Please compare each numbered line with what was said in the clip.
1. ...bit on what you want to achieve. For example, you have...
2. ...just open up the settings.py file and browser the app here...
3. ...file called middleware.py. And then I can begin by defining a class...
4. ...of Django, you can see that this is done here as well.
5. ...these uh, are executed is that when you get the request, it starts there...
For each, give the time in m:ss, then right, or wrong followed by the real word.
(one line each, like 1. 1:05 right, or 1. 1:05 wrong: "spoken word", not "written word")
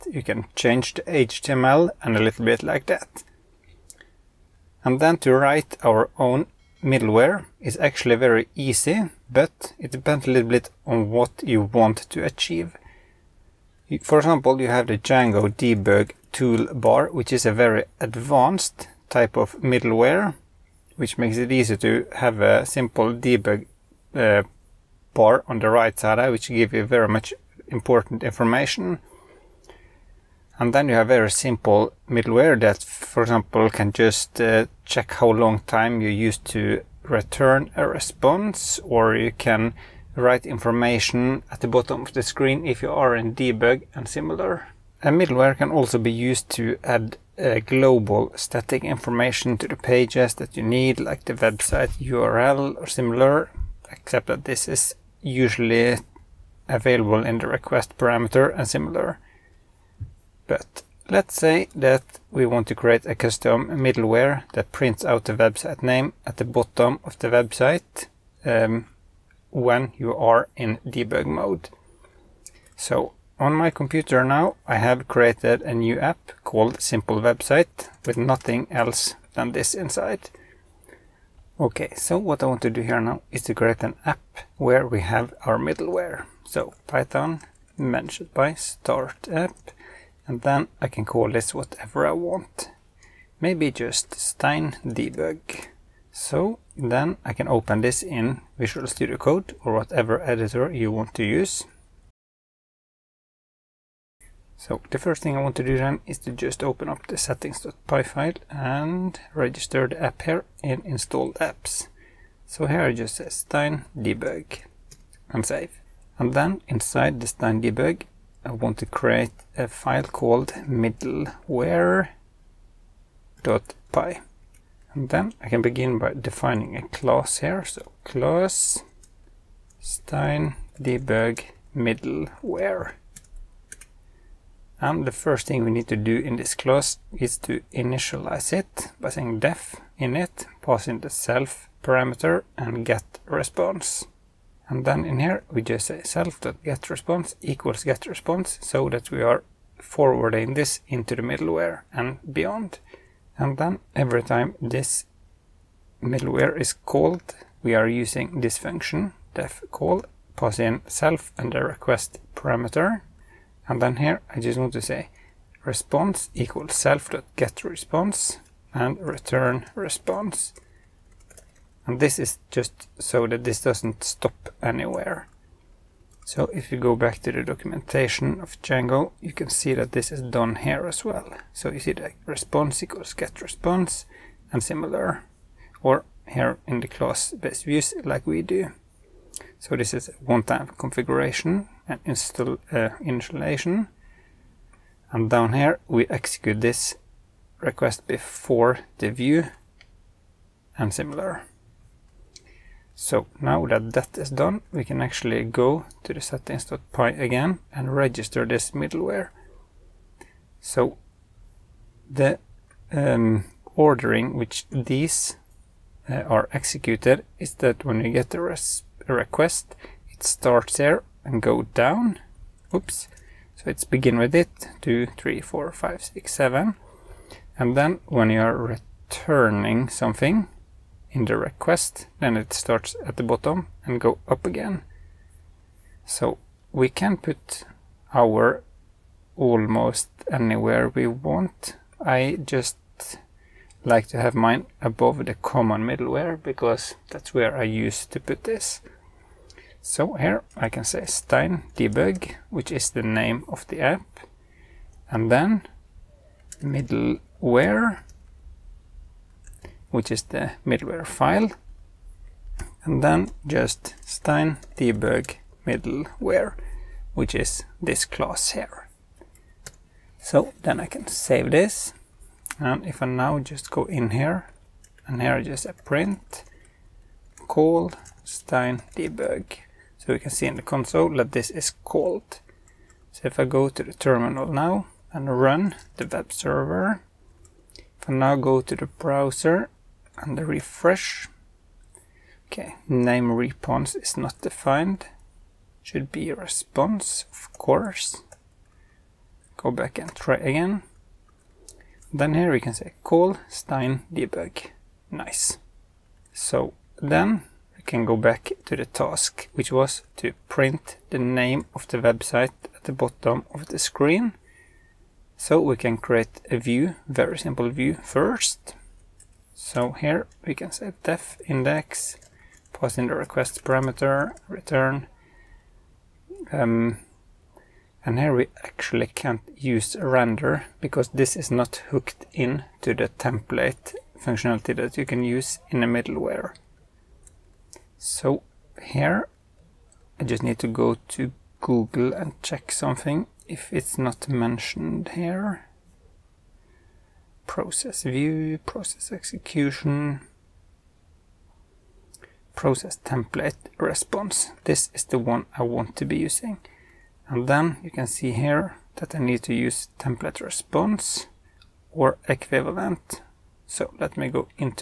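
1. 0:10 right
2. 1:46 wrong: "register", not "browser"
3. 1:59 right
4. 2:58 right
5. 3:34 right.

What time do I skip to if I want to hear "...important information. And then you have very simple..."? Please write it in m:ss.
0:27.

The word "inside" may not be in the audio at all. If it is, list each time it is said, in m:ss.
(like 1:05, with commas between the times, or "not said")
1:19, 1:56.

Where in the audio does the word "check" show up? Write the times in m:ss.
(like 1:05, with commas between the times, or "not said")
0:34, 5:42.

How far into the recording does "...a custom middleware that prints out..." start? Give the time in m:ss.
1:03.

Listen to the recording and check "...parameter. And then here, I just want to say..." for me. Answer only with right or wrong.
right.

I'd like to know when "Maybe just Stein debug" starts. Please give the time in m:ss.
1:33.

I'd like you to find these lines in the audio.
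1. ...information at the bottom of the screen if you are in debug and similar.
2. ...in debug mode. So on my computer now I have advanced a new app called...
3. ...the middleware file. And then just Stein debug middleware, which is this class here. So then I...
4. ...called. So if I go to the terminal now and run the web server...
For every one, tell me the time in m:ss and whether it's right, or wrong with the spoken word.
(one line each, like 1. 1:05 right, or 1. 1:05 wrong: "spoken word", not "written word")
1. 0:40 right
2. 1:10 wrong: "created", not "advanced"
3. 4:20 right
4. 4:41 right.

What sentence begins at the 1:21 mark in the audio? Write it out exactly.
Okay, so what I want to do here now is to create an app where we have our middleware.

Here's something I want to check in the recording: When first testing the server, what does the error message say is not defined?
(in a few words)
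name response.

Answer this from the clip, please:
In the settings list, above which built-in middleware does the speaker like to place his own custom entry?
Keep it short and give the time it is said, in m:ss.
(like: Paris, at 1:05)
common middleware, at 4:05.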